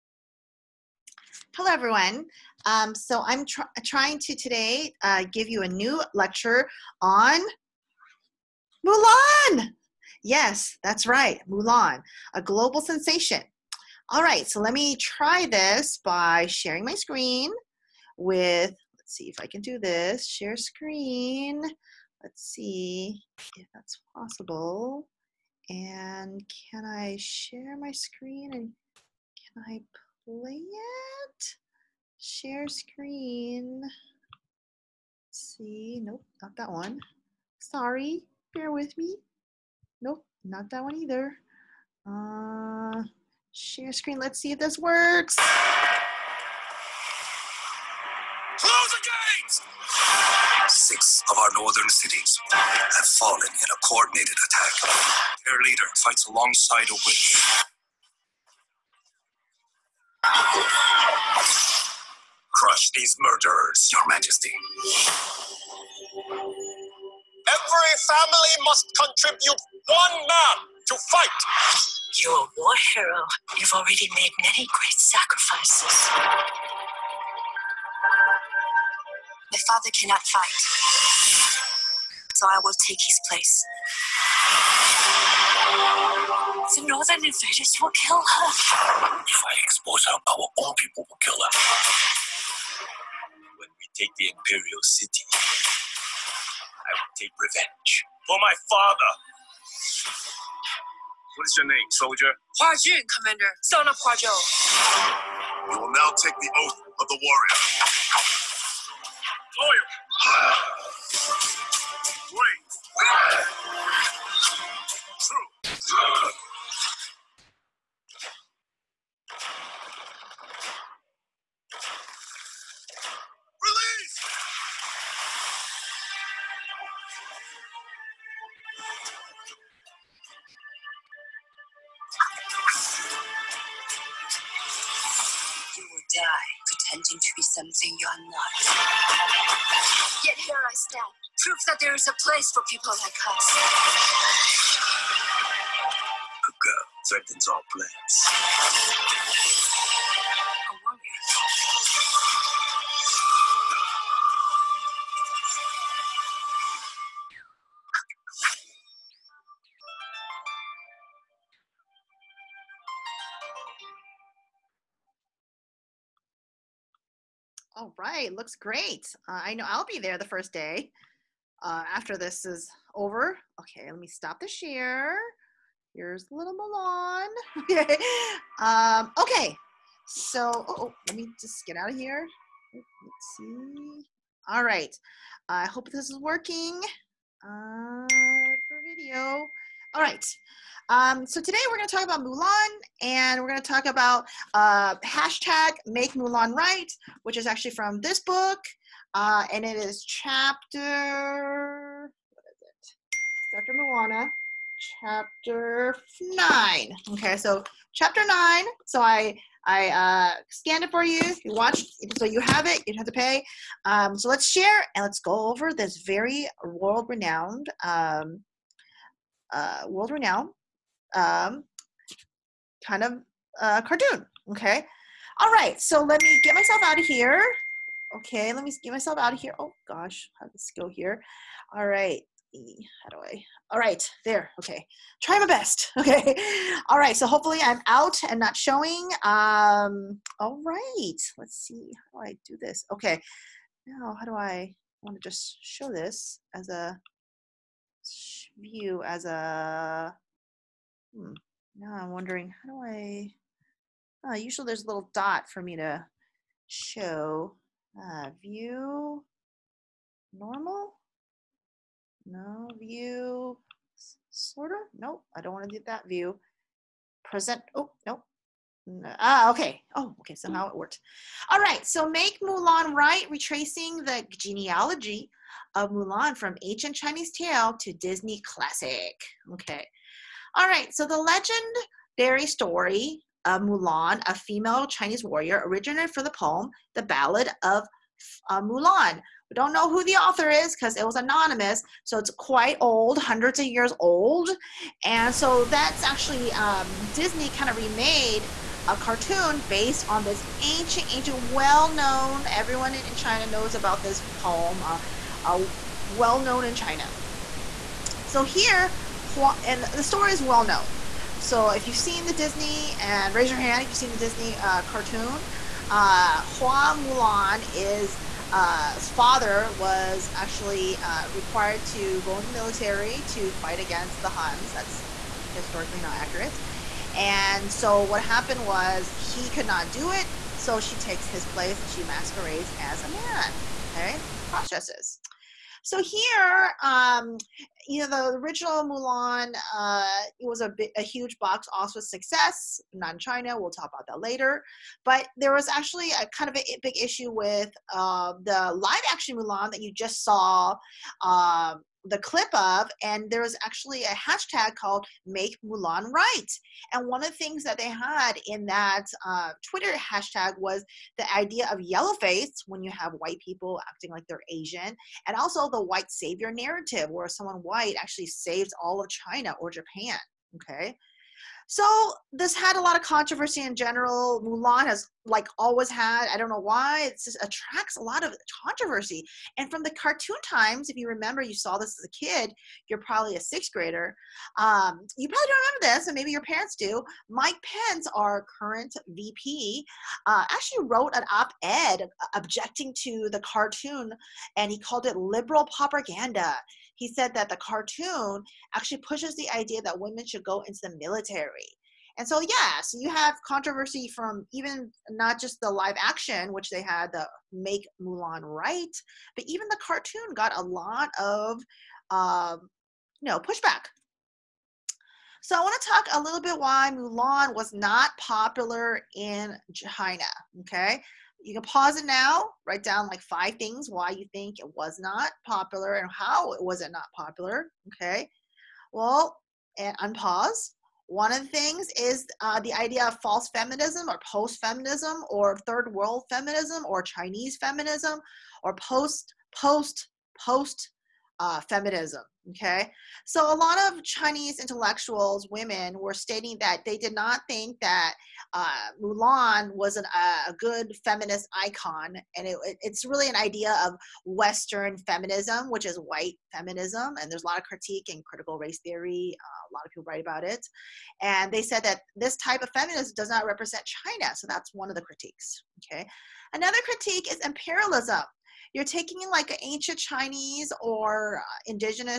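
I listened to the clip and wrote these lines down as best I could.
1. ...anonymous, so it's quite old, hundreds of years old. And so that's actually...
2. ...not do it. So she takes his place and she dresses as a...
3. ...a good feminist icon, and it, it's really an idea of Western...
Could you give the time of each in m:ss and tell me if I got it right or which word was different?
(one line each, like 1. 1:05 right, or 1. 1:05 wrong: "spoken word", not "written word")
1. 4:51 right
2. 5:29 wrong: "masquerades", not "dresses"
3. 7:30 right.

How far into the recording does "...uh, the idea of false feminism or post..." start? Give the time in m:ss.
7:12.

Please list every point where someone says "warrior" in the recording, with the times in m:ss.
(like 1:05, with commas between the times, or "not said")
1:47, 4:45.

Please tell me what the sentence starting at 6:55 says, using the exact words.
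So I want to talk a little bit why Mulan was not popular in China.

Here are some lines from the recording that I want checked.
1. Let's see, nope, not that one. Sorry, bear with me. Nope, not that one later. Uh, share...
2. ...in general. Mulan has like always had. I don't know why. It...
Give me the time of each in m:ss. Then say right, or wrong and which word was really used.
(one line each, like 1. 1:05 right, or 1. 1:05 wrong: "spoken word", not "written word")
1. 0:33 wrong: "either", not "later"
2. 6:13 right.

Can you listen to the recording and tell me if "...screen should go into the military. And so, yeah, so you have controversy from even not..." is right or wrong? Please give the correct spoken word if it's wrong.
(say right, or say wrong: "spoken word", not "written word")
wrong: "women", not "screen".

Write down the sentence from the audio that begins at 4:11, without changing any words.
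Now I'm wondering, how do I, uh, usually there's a little dot for me to show.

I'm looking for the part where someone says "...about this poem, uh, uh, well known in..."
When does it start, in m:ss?
5:03.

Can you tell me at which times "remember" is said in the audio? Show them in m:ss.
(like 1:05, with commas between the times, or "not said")
6:21, 6:25.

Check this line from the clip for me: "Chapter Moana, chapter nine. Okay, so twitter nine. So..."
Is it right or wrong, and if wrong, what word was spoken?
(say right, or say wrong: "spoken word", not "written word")
wrong: "chapter", not "twitter".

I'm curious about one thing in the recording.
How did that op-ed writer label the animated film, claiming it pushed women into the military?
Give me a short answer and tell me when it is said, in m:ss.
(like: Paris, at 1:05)
liberal propaganda, at 6:35.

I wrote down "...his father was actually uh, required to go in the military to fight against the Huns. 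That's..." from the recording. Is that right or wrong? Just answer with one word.
right.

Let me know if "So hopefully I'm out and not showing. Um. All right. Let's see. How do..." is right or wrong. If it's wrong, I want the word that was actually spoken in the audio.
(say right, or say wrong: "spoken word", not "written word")
right.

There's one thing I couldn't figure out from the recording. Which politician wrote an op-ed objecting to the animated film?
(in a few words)
Mike Pence.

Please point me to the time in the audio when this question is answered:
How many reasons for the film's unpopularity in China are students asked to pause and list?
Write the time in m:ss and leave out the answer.
7:03.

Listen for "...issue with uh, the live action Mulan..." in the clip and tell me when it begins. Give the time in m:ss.
5:46.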